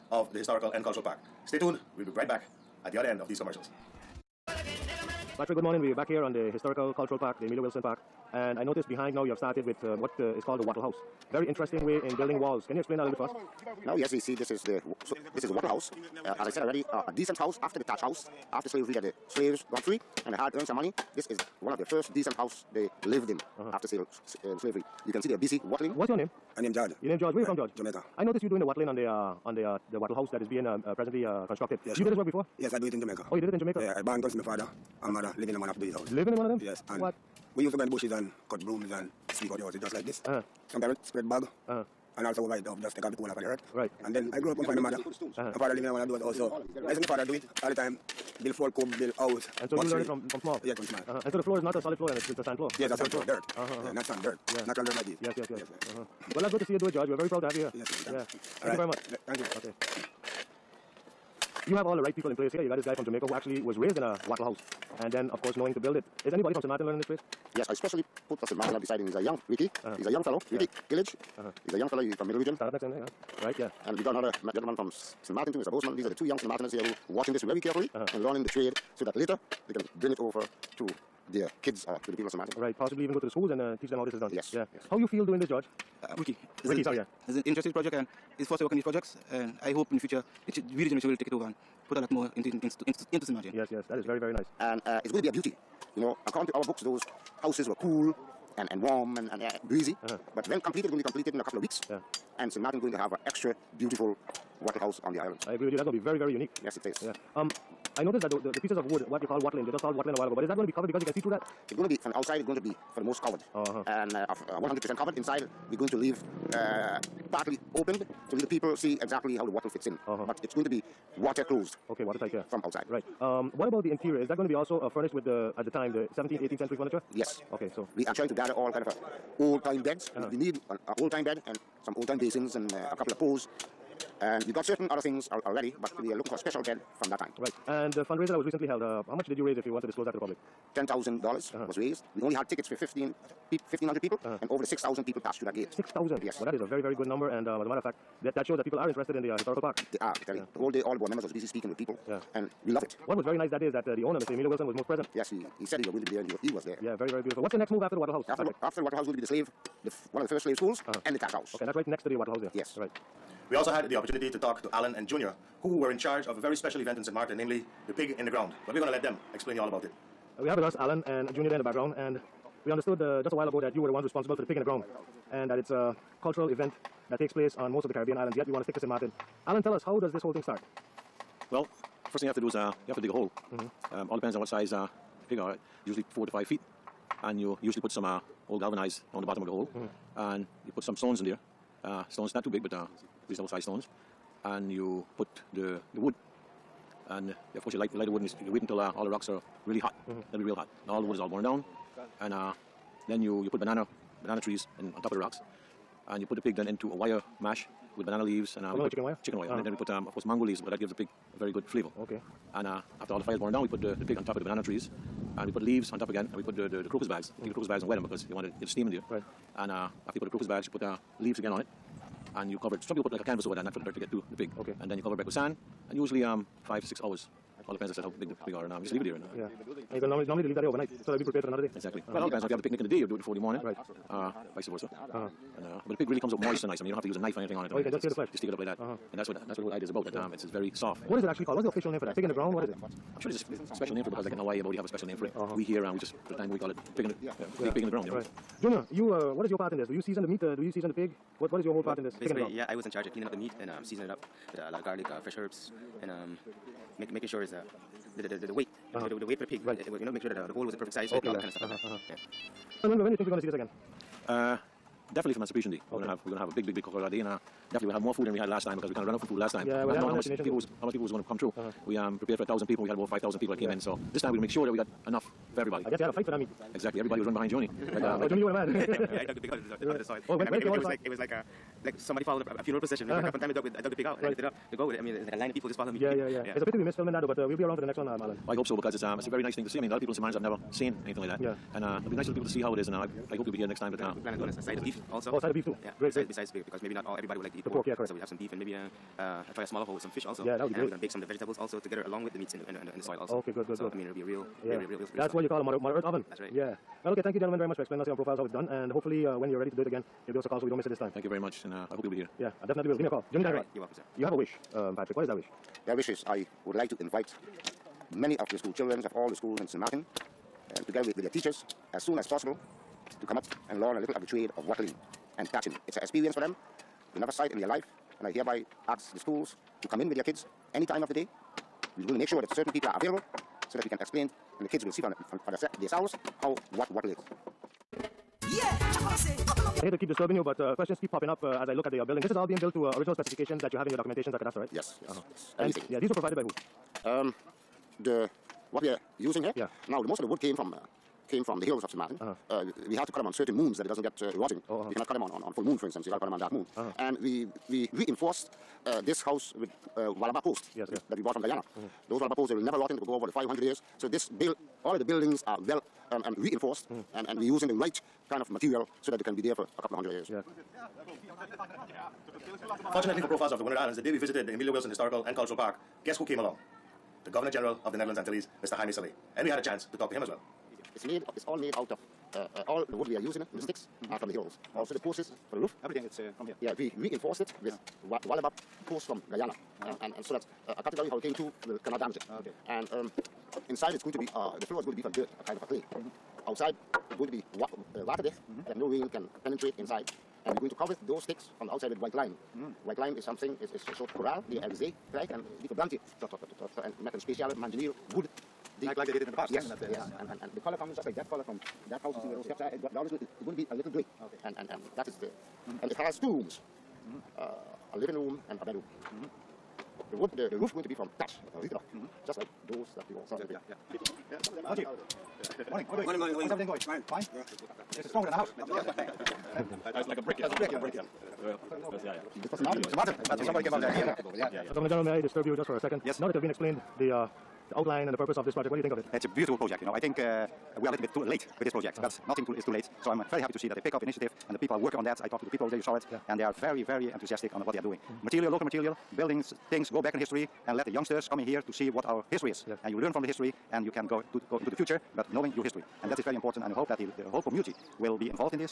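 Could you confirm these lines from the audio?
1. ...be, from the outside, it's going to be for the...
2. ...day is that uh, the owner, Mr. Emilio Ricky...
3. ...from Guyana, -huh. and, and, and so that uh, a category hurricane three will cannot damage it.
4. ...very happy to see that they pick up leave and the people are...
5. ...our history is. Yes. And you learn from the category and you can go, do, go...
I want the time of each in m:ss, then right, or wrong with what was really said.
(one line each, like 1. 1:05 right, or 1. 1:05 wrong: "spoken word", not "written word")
1. 1:51 right
2. 2:33 wrong: "Wilson", not "Ricky"
3. 6:29 wrong: "two", not "three"
4. 7:23 wrong: "initiative", not "leave"
5. 7:32 wrong: "history", not "category".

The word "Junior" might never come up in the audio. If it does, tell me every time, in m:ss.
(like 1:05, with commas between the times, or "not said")
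2:45, 2:51, 4:08.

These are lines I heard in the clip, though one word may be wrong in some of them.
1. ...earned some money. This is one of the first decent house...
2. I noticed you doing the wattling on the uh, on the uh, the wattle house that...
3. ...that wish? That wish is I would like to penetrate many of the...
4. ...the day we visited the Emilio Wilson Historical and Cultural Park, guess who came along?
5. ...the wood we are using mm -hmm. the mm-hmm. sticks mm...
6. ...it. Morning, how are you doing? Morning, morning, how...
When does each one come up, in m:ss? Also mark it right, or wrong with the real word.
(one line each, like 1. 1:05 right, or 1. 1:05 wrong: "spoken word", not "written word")
1. 0:20 right
2. 0:28 right
3. 5:15 wrong: "invite", not "penetrate"
4. 6:13 right
5. 6:22 right
6. 7:04 right.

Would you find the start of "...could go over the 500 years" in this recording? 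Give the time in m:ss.
6:02.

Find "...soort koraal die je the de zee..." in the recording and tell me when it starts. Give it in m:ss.
6:43.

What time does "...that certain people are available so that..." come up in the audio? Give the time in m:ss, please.
5:32.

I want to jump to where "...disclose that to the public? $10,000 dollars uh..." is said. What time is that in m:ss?
2:19.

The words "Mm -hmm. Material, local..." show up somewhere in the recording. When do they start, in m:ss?
7:27.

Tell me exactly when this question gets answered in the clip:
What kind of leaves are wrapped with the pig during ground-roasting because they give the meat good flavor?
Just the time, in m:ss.
3:30.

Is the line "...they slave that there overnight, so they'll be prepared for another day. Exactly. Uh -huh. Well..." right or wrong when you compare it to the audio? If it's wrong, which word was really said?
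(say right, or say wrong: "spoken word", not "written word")
wrong: "leave", not "slave".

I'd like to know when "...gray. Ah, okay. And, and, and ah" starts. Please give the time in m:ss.
6:53.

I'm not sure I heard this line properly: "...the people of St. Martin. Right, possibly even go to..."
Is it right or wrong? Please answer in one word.
right.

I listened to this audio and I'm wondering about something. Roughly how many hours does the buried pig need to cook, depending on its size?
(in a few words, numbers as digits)
5 to 6 hours.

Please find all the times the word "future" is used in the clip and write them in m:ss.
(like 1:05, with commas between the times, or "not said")
1:29, 7:34.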